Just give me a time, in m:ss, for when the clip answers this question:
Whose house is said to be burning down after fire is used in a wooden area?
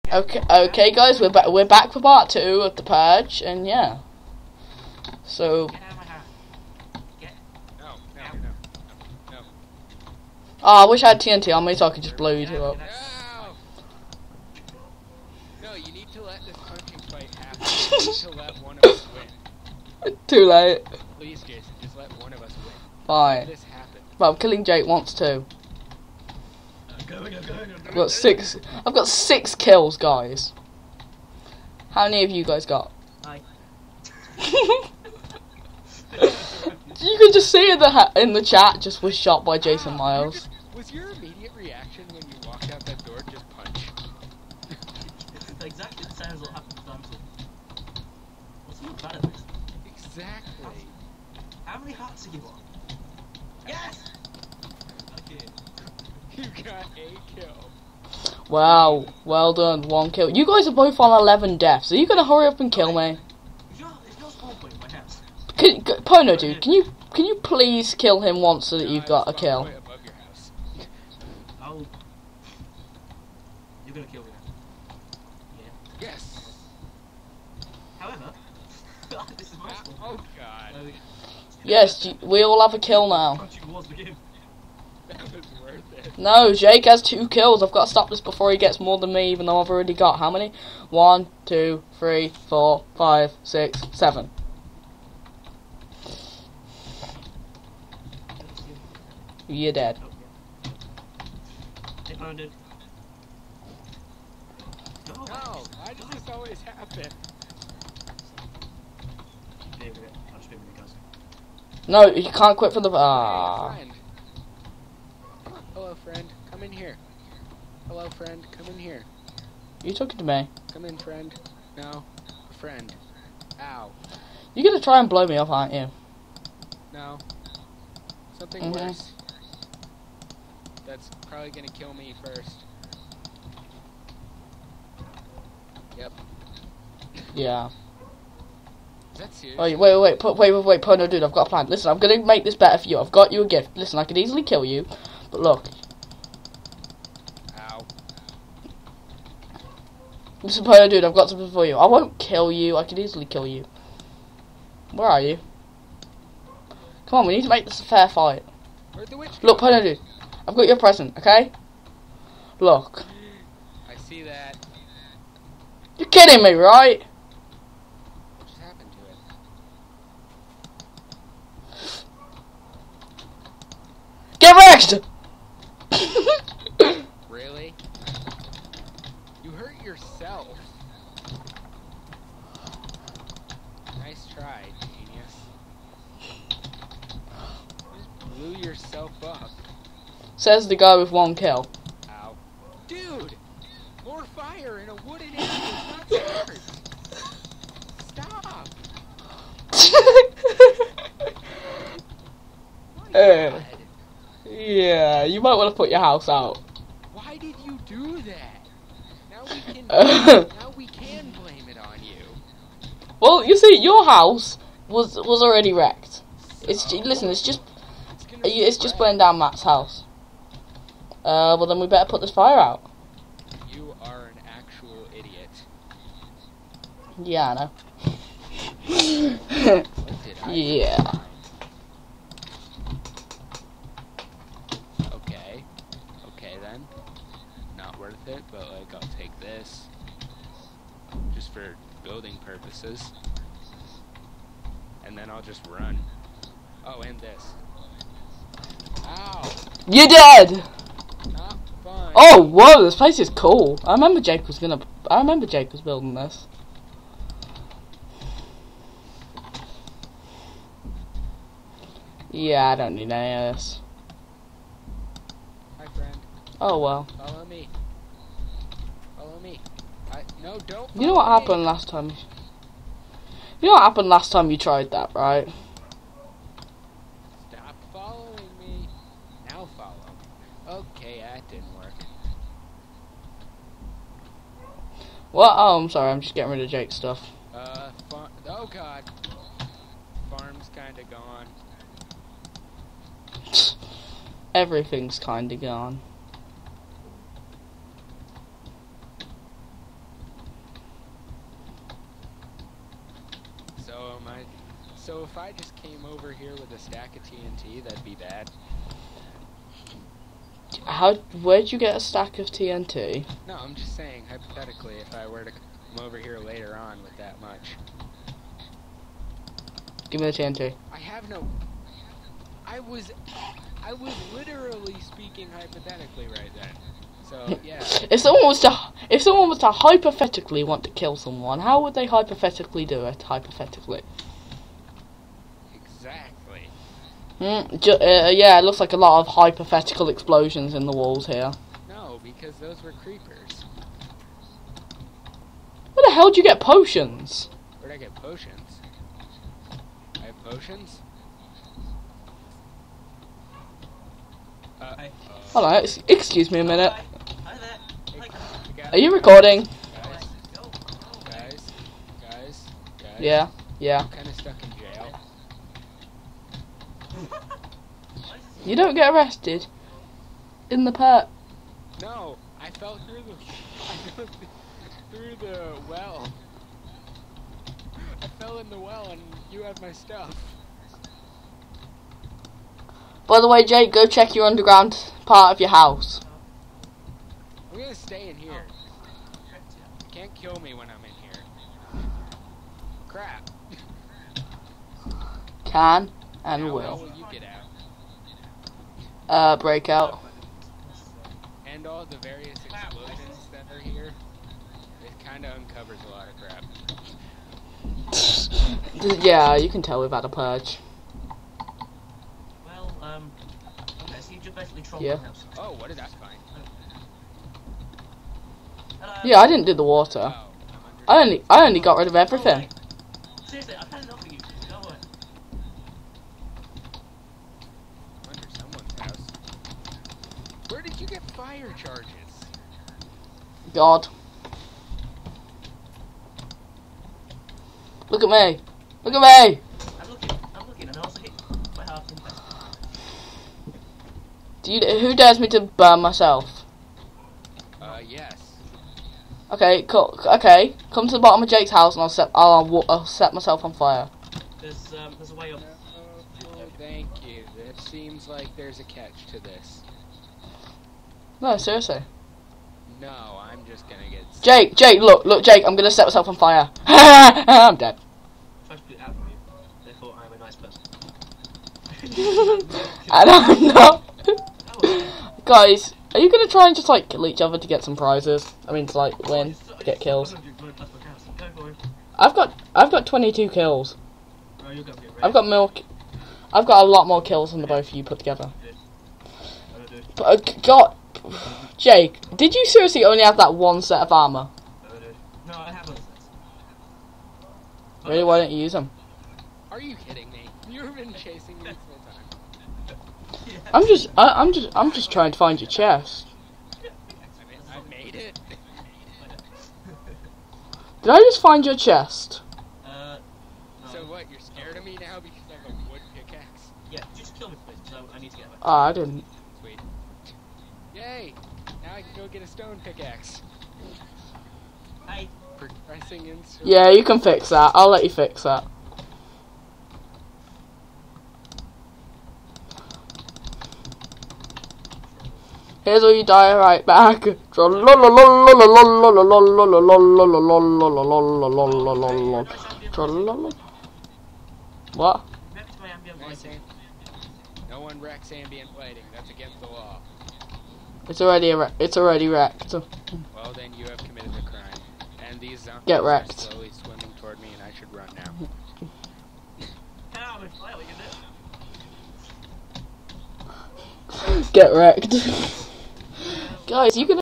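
3:39.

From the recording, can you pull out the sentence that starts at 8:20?
You've been chasing me this whole time.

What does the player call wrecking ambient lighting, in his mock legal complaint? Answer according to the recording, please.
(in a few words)
Against the law.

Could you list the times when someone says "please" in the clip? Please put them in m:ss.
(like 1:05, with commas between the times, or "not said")
0:21, 1:07, 8:37.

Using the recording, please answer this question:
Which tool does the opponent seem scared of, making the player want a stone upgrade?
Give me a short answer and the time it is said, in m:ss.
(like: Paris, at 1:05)
Wood pickaxe, at 8:35.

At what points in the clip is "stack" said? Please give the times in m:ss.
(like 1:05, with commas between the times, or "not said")
5:06, 5:11.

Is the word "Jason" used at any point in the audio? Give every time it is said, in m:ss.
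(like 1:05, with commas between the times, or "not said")
0:21, 0:39.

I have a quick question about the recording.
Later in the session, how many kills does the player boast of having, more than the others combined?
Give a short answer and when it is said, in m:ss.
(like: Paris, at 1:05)
22, at 8:03.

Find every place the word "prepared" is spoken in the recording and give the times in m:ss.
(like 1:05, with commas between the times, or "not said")
not said.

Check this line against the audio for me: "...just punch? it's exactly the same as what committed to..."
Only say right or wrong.
wrong.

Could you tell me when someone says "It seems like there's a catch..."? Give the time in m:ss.
7:37.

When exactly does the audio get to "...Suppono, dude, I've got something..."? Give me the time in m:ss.
2:30.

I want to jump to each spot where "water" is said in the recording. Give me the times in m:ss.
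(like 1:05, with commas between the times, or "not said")
6:59.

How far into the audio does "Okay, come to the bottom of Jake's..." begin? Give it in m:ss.
7:30.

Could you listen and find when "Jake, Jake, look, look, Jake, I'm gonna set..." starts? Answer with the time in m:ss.
7:44.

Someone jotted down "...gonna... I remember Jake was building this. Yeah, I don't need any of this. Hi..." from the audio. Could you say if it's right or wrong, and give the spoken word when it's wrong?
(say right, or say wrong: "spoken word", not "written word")
right.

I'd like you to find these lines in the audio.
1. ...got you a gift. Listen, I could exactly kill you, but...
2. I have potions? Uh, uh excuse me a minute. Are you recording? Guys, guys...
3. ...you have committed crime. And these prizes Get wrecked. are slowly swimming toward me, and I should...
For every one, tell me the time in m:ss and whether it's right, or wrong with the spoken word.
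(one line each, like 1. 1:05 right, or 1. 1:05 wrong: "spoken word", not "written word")
1. 2:23 wrong: "easily", not "exactly"
2. 5:50 right
3. 9:13 wrong: "zombies", not "prizes".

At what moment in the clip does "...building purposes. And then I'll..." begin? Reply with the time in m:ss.
4:02.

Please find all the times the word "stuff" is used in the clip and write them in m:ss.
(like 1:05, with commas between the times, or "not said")
4:46, 6:19.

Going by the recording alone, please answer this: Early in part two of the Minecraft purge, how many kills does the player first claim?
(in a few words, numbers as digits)
6.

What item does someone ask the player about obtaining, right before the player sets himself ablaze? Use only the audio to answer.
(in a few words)
Fire charges.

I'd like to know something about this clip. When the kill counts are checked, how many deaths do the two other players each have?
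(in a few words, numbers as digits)
11.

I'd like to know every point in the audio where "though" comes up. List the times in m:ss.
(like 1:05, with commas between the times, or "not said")
1:29.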